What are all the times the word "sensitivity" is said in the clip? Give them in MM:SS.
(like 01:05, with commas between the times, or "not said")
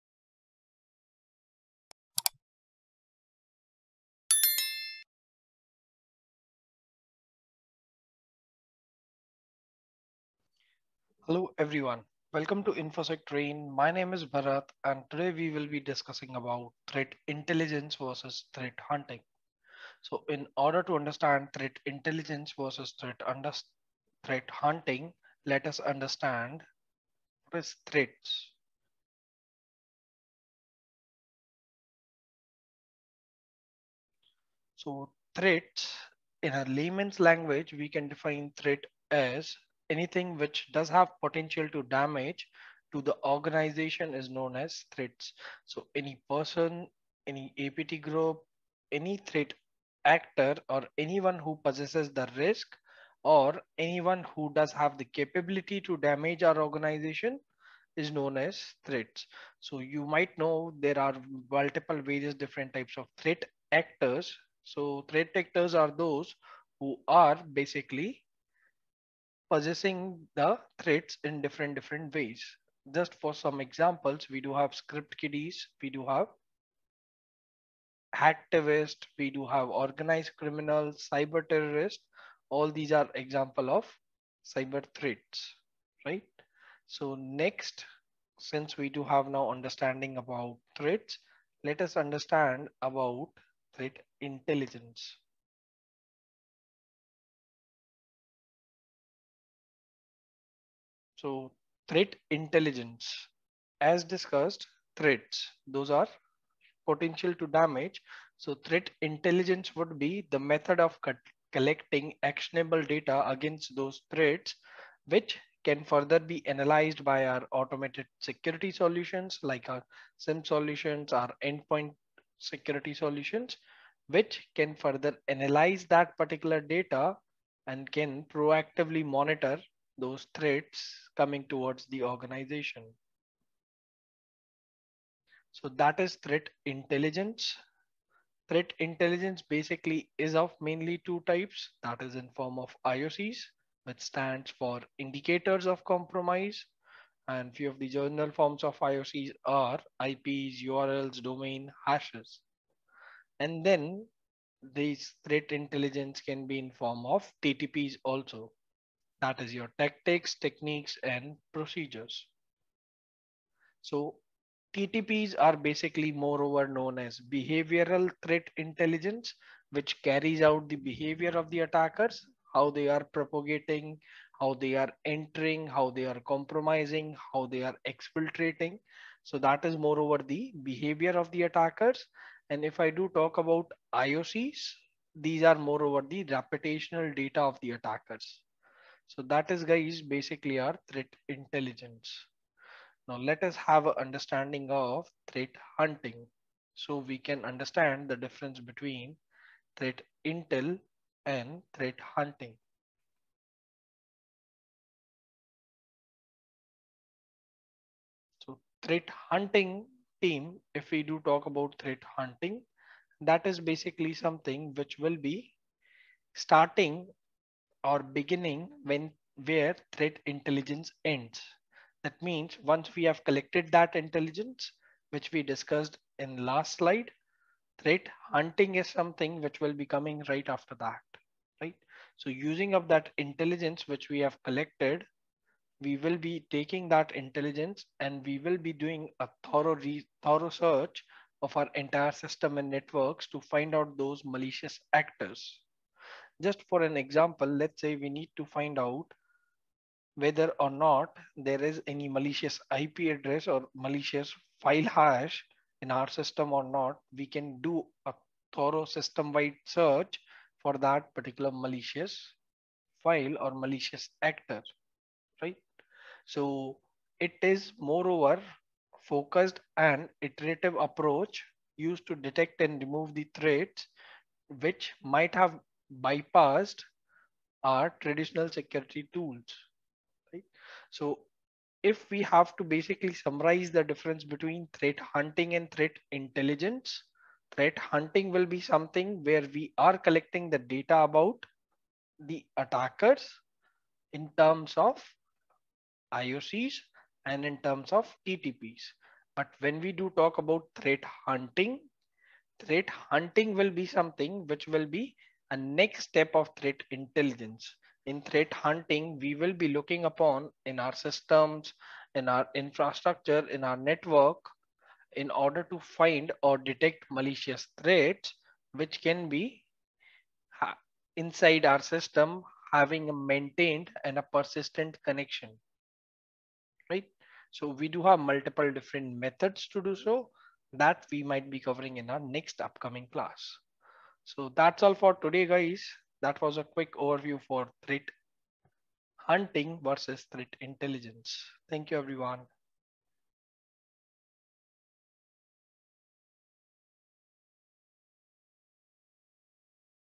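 not said.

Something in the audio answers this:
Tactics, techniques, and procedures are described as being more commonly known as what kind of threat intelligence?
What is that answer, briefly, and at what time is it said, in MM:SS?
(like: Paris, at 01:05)
behavioral threat intelligence, at 02:47.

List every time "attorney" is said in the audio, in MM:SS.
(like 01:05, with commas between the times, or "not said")
not said.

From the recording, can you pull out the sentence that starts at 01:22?
All these are example of cyber threats, right?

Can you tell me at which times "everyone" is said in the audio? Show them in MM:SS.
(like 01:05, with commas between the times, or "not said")
00:11, 05:41.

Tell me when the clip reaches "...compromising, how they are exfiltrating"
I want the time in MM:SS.
02:56.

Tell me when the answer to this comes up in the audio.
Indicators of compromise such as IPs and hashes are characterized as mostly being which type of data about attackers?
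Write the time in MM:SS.
03:06.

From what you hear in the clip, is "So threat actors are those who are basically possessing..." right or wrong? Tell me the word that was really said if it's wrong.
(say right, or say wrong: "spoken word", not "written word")
right.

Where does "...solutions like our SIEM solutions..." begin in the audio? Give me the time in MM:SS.
01:58.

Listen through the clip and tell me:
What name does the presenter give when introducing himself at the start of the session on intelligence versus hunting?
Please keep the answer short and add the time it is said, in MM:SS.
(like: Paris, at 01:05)
Bharat, at 00:14.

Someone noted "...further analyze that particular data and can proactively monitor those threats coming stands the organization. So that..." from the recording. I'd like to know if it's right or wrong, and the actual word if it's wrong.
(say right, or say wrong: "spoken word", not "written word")
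wrong: "towards", not "stands".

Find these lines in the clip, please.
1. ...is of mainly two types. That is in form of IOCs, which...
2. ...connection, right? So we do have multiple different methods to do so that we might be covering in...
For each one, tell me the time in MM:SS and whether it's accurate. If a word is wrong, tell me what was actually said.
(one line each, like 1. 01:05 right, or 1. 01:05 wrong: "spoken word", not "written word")
1. 02:20 right
2. 05:25 right.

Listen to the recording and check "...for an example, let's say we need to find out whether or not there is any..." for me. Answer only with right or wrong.
right.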